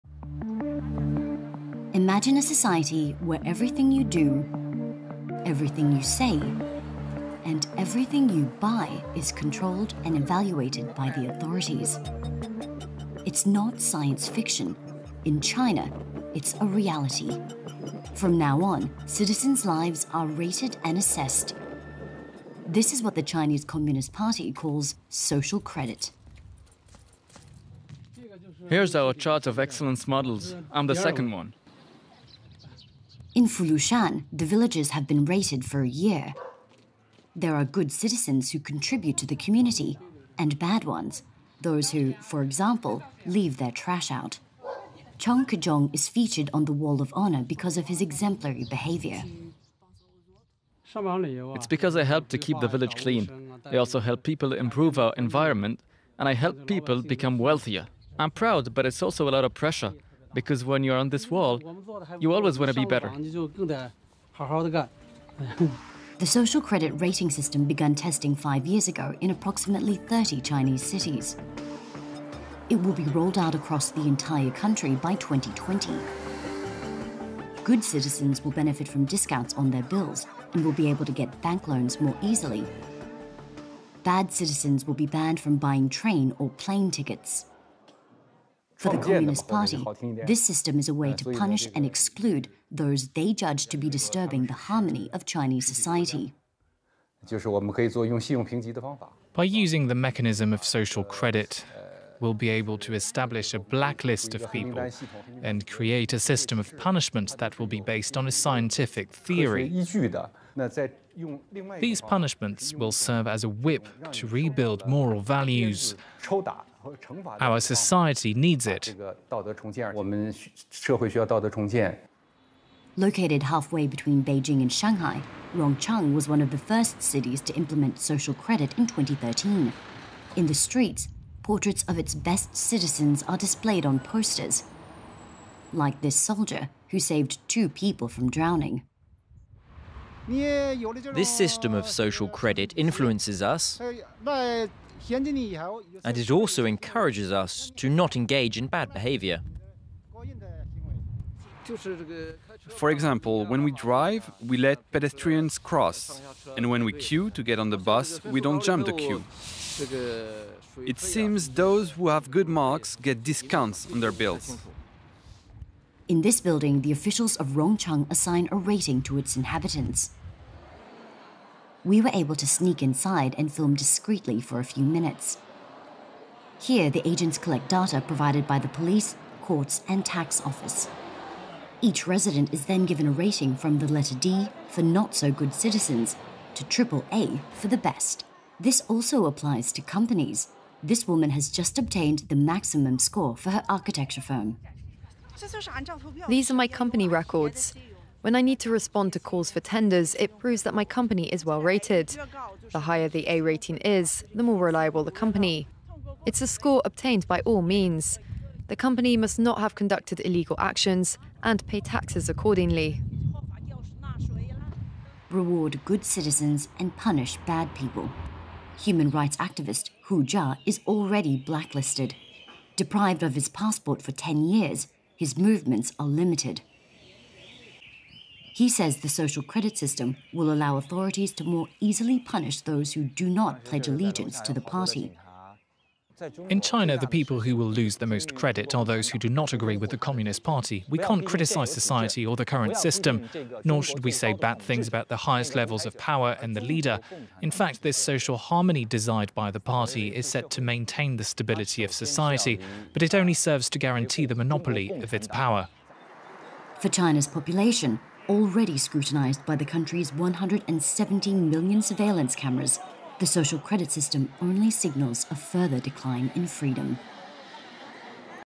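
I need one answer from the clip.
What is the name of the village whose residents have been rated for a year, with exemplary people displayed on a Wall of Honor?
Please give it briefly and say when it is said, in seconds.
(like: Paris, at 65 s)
Fulushan, at 33 s.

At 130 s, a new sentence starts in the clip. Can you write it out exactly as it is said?
In the streets, portraits of its best citizens are displayed on posters.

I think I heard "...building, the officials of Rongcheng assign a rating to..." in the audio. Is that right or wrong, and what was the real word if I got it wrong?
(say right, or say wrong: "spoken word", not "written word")
right.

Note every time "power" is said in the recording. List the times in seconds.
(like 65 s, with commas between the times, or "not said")
245 s, 255 s.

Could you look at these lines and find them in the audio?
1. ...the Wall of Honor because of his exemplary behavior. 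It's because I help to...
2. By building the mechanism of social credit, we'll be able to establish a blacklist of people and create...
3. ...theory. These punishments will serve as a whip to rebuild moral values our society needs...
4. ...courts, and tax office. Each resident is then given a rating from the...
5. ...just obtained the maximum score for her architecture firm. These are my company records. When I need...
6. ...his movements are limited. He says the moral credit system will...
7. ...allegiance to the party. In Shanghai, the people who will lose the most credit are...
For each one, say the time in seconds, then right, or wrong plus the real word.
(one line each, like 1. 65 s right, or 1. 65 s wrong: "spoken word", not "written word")
1. 46 s right
2. 99 s wrong: "using", not "building"
3. 109 s right
4. 179 s right
5. 191 s right
6. 225 s wrong: "social", not "moral"
7. 233 s wrong: "China", not "Shanghai".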